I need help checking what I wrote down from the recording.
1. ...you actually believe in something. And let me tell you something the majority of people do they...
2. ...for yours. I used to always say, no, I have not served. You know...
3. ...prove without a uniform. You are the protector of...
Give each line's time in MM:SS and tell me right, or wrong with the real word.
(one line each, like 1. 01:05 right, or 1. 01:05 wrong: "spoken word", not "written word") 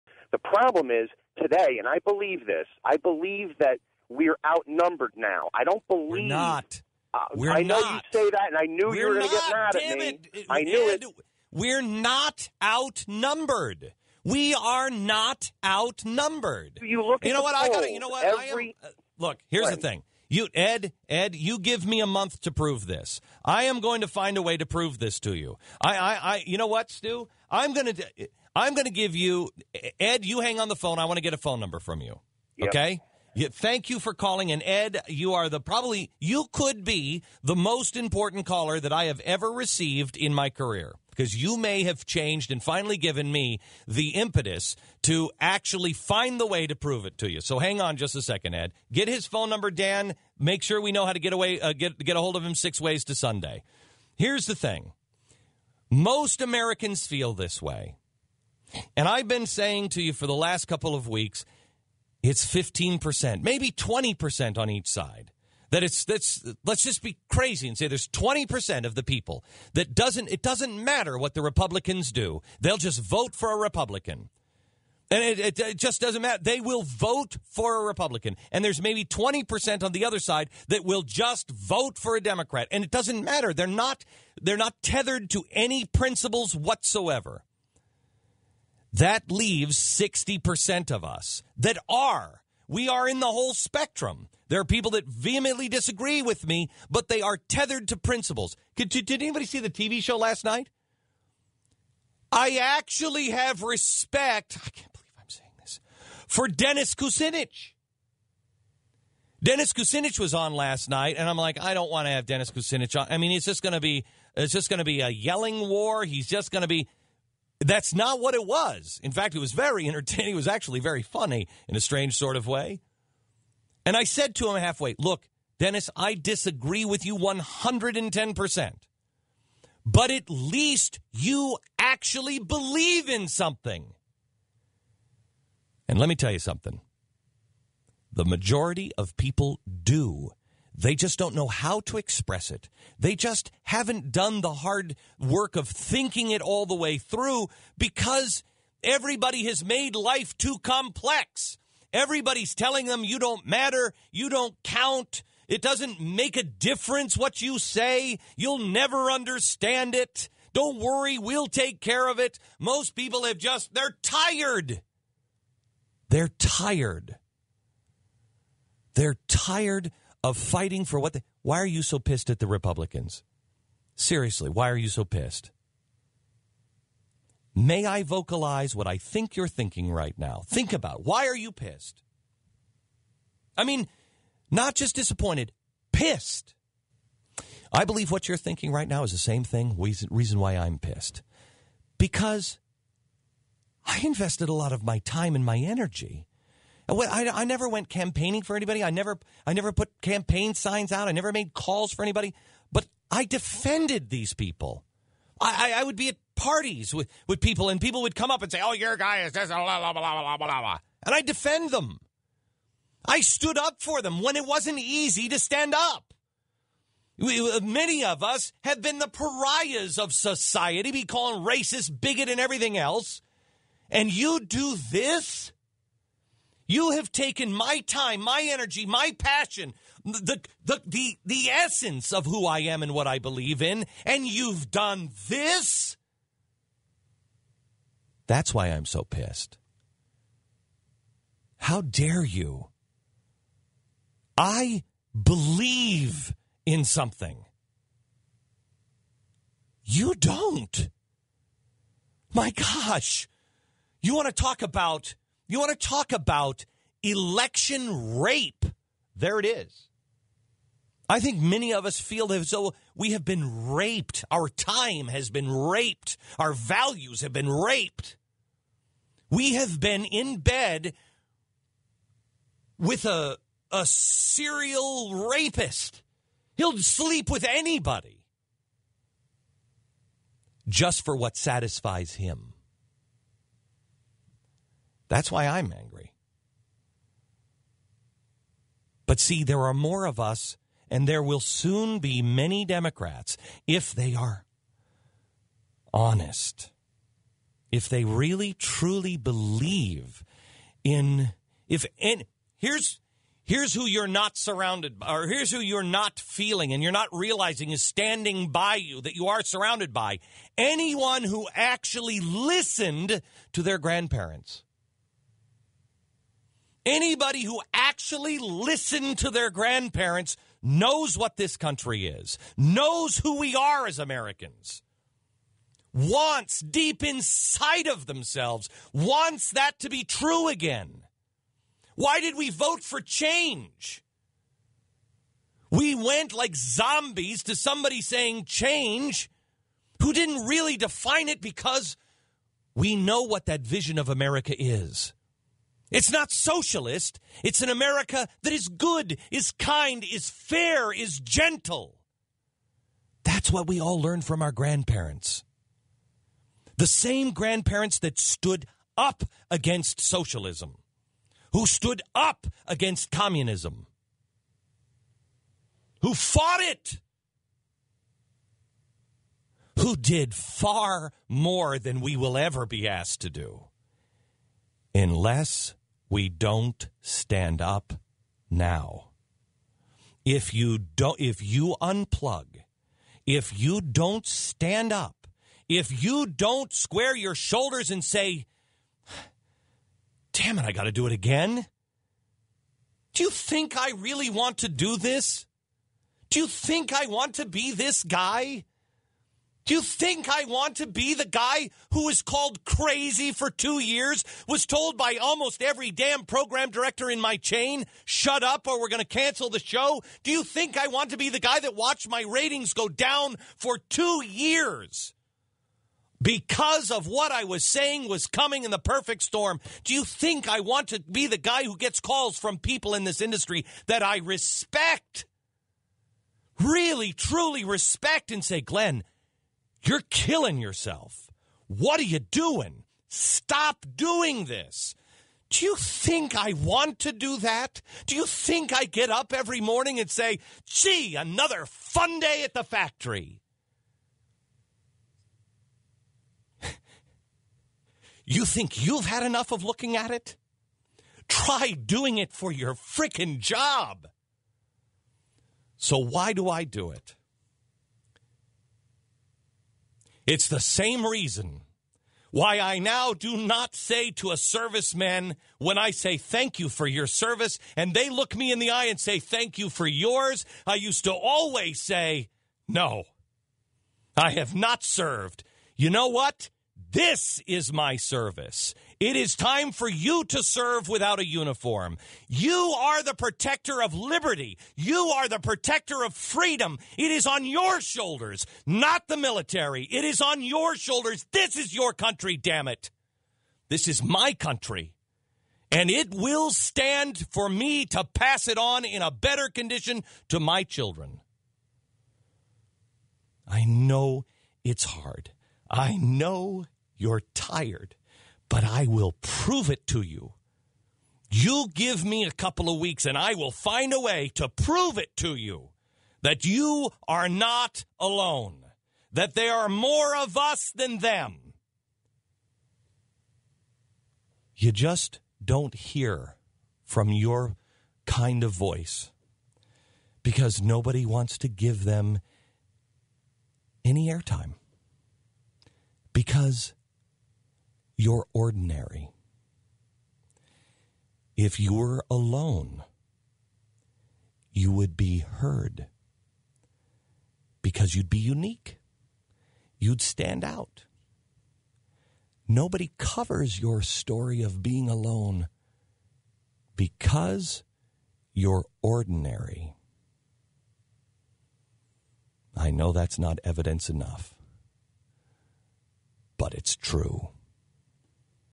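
1. 02:11 right
2. 07:49 right
3. 08:00 wrong: "serve", not "prove".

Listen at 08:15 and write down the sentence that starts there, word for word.
And it will stand for me to pass it on in a better condition to my children.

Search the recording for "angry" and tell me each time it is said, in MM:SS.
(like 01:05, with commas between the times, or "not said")
04:45.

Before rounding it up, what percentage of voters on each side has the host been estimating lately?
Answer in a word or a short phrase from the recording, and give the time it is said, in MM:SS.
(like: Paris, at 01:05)
15%, at 01:02.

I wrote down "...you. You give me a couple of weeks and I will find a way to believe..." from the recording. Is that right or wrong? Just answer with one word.
wrong.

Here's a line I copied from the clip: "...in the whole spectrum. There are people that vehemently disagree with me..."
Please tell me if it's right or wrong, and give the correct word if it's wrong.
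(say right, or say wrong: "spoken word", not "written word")
right.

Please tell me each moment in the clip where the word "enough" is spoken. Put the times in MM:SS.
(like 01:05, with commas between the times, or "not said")
07:29, 09:23.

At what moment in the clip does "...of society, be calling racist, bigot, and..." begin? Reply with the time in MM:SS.
03:39.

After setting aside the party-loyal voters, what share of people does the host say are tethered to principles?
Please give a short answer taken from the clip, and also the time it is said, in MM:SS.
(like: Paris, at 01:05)
60%, at 01:29.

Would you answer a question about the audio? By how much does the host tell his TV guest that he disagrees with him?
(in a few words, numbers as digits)
110%.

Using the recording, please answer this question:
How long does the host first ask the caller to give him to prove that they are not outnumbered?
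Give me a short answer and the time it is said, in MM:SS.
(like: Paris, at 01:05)
a month, at 00:21.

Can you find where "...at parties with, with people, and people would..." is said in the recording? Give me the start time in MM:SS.
03:26.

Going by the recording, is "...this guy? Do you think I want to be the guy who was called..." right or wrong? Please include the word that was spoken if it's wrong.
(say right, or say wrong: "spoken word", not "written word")
right.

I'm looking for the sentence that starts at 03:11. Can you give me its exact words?
Because I invested a lot of my time and my energy I, I never went campaigning for anybody.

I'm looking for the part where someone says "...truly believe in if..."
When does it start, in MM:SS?
04:58.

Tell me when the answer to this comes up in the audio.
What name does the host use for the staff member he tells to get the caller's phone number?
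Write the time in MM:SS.
00:49.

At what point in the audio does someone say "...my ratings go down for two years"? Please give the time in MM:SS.
06:52.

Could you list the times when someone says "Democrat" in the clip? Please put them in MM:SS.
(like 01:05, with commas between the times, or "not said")
01:22, 04:52.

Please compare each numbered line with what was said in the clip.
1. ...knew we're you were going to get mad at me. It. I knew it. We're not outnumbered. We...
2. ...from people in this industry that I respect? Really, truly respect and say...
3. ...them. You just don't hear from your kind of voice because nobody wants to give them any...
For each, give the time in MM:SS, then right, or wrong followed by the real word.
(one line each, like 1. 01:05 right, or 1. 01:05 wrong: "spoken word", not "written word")
1. 00:08 right
2. 07:02 right
3. 08:40 right.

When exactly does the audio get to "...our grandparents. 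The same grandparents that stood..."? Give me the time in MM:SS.
05:54.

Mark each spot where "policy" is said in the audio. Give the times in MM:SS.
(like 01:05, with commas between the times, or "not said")
not said.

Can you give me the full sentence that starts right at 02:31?
Everybody's telling them you don't matter, you don't count, it doesn't make a difference what you say, you'll never understand it.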